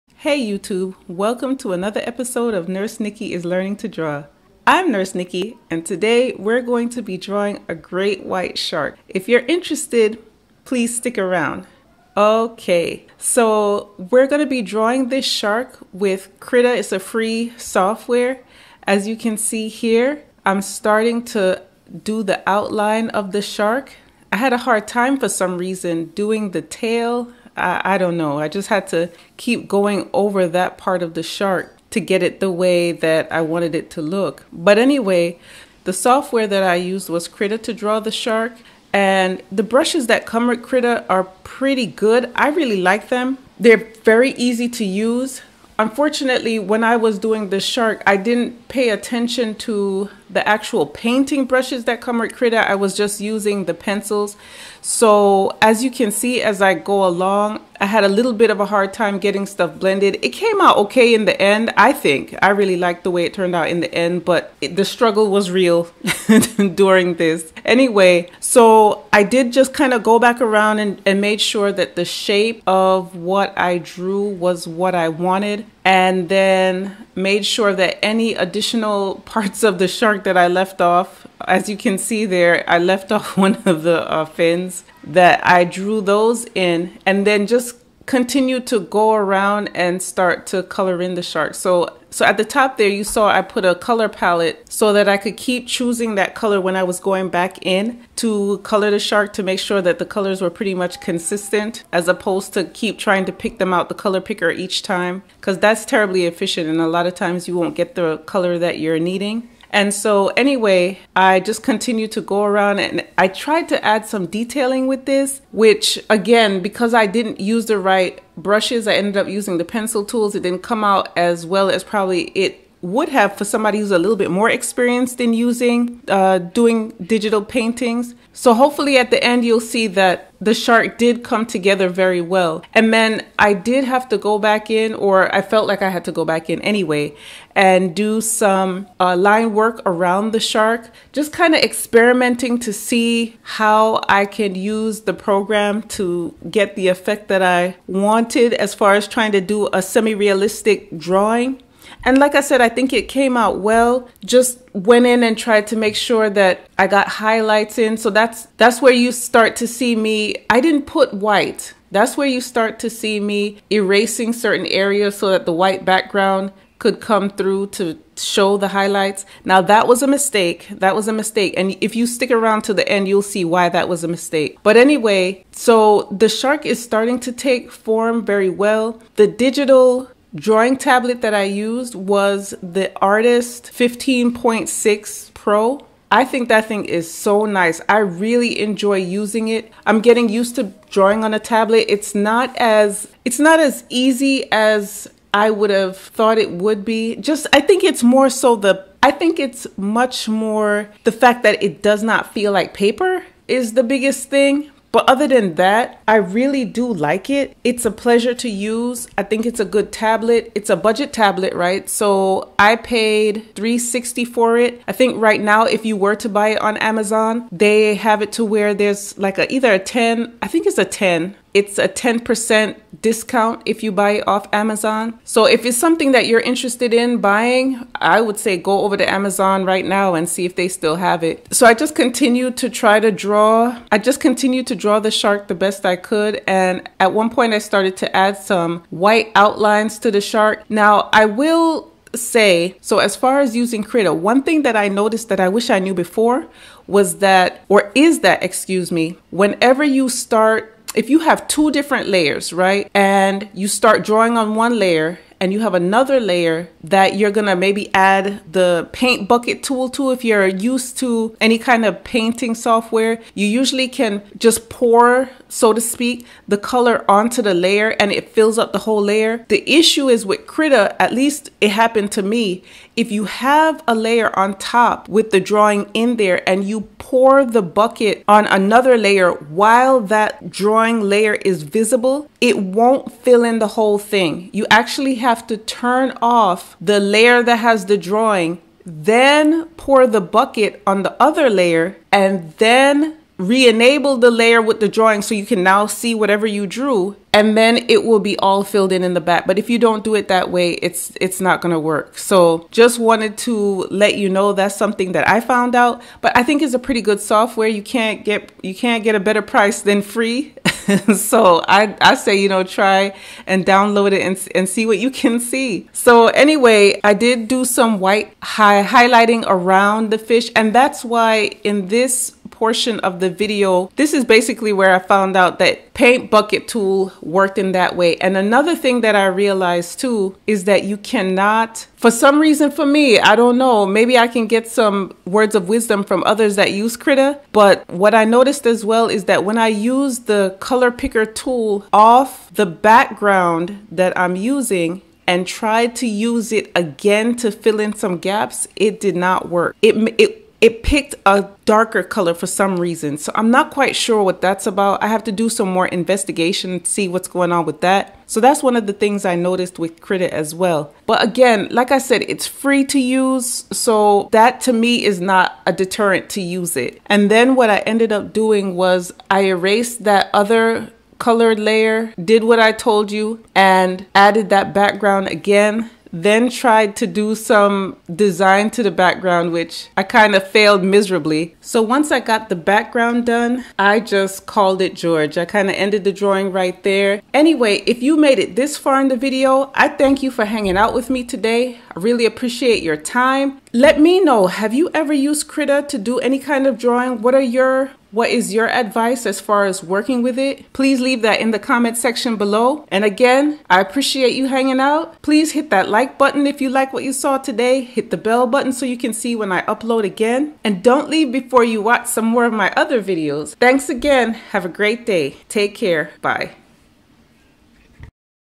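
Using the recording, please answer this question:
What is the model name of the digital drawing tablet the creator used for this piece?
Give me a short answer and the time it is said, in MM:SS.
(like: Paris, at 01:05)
Artist 15.6 Pro, at 03:03.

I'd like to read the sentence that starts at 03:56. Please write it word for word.
And at one point I started to add some white outlines to the shark.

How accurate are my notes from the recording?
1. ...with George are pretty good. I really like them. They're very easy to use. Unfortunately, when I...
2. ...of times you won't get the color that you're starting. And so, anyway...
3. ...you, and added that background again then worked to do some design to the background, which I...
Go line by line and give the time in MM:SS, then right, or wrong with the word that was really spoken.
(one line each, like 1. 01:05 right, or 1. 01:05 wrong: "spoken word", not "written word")
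1. 00:40 wrong: "Krita", not "George"
2. 01:47 wrong: "needing", not "starting"
3. 06:13 wrong: "tried", not "worked".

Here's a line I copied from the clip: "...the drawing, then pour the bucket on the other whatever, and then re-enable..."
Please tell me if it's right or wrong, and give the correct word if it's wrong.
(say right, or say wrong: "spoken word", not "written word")
wrong: "layer", not "whatever".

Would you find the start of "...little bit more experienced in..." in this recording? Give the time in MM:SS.
02:03.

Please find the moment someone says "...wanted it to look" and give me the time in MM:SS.
00:33.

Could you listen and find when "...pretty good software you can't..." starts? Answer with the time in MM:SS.
05:06.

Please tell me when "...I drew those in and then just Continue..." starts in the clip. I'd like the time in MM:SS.
01:25.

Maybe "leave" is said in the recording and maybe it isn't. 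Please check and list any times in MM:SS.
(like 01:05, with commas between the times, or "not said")
06:40, 06:51.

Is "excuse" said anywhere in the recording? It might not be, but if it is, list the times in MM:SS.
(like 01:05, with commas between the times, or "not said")
04:08.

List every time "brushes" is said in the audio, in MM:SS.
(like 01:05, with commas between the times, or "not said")
00:39, 00:51, 01:58.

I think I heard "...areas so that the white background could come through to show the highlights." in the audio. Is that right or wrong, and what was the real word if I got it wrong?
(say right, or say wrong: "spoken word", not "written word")
right.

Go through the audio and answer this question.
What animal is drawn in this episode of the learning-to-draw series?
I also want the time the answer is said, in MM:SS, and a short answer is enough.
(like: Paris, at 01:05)
great white shark, at 00:07.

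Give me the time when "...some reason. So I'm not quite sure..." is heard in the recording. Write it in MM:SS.
05:52.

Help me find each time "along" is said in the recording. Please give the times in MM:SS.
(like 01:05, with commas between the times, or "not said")
00:57.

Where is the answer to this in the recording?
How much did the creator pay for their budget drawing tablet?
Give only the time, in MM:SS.
03:33.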